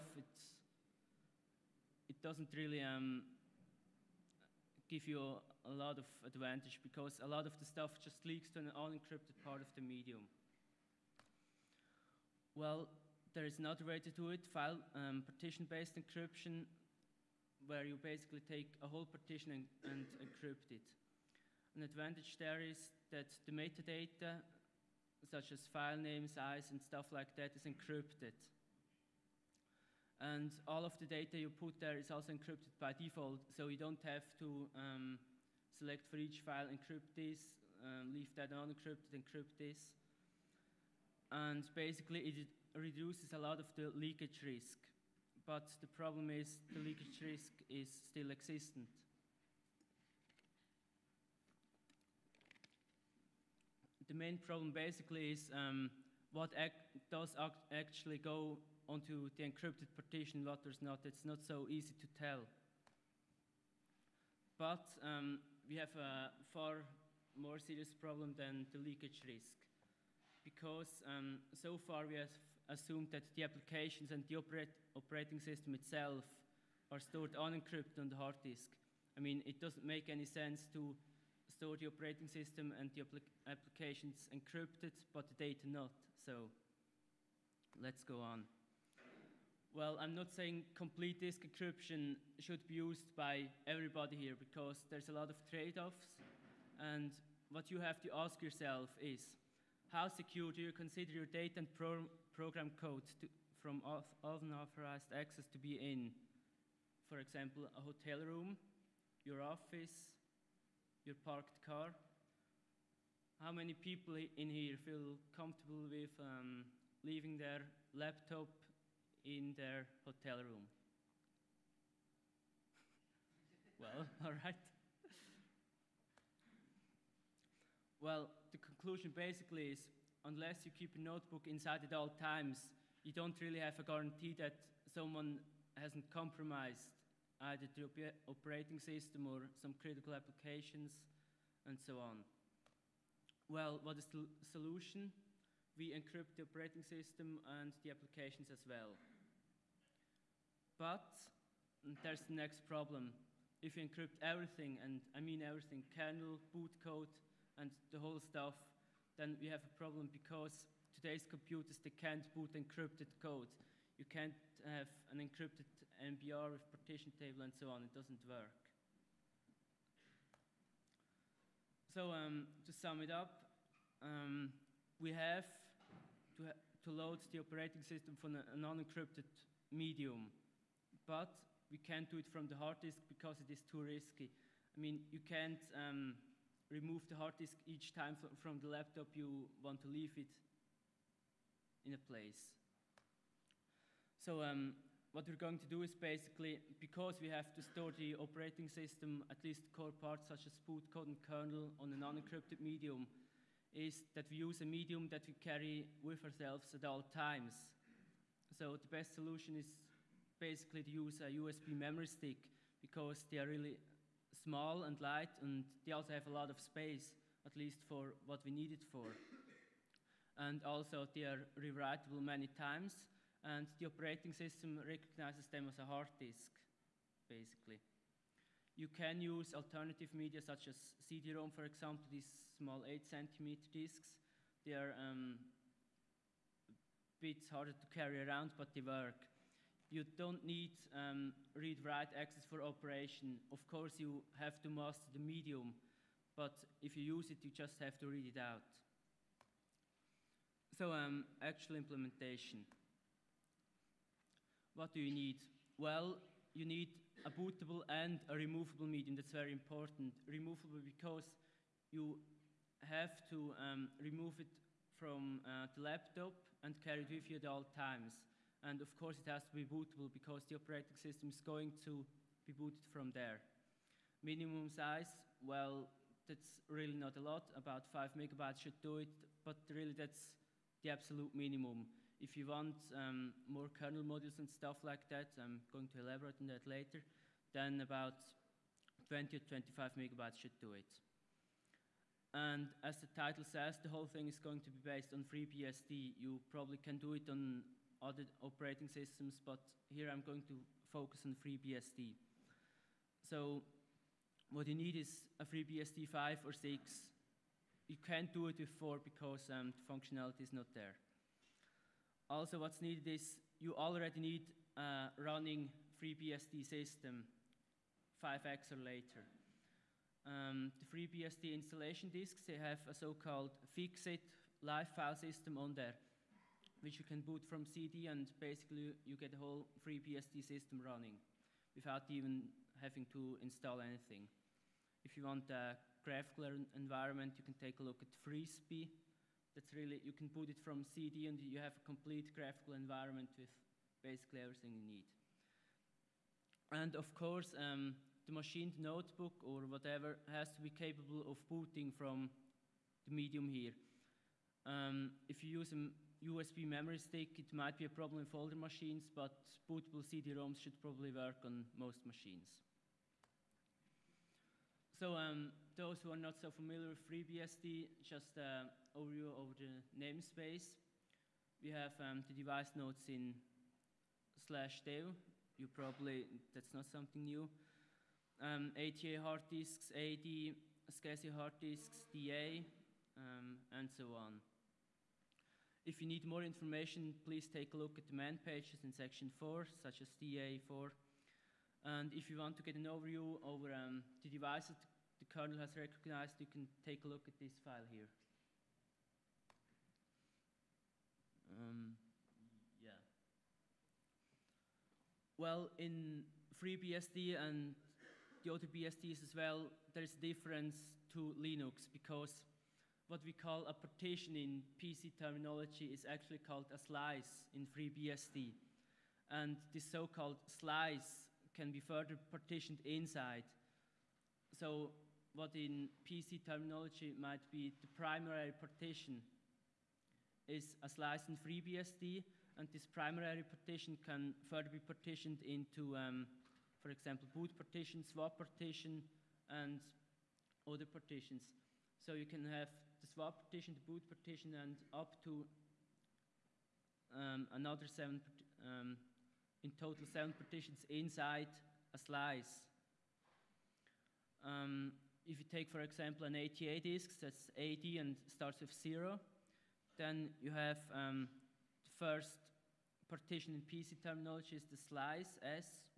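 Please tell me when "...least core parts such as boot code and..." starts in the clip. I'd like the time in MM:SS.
03:19.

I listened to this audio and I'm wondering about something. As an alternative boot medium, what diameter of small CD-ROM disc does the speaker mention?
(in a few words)
8 centimeter.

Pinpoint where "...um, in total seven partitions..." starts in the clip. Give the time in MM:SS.
07:28.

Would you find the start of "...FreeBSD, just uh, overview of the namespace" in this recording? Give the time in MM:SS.
06:07.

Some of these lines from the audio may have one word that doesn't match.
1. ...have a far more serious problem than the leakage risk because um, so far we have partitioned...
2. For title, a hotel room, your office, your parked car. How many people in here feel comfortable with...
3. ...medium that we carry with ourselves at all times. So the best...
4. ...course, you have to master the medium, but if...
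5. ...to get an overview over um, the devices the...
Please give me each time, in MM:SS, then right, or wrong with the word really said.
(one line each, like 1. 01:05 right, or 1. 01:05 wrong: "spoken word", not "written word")
1. 01:05 wrong: "assumed", not "partitioned"
2. 01:47 wrong: "example", not "title"
3. 03:24 right
4. 04:03 right
5. 06:32 right.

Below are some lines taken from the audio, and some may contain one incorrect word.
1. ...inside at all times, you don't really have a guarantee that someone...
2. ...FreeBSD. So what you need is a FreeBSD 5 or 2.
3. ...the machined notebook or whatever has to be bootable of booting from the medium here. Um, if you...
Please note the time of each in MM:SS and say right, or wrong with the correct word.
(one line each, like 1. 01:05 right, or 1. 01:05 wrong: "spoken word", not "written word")
1. 02:11 right
2. 05:01 wrong: "6", not "2"
3. 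05:48 wrong: "capable", not "bootable".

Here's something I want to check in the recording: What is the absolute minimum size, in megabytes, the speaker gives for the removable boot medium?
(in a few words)
5 megabytes.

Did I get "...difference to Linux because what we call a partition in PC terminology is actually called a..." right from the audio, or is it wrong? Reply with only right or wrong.
right.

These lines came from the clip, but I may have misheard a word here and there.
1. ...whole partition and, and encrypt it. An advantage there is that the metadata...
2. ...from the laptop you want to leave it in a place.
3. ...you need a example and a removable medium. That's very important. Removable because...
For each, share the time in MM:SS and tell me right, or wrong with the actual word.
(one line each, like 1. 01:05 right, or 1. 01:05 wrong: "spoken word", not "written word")
1. 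00:18 right
2. 03:08 right
3. 04:16 wrong: "bootable", not "example".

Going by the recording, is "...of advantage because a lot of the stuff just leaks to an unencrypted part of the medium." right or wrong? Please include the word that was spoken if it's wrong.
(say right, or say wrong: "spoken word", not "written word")
right.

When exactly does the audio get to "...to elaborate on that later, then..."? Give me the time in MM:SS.
04:45.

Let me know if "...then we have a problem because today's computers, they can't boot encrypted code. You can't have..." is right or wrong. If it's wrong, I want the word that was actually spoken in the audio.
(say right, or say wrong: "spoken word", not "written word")
right.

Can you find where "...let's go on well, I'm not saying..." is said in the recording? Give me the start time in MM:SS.
01:27.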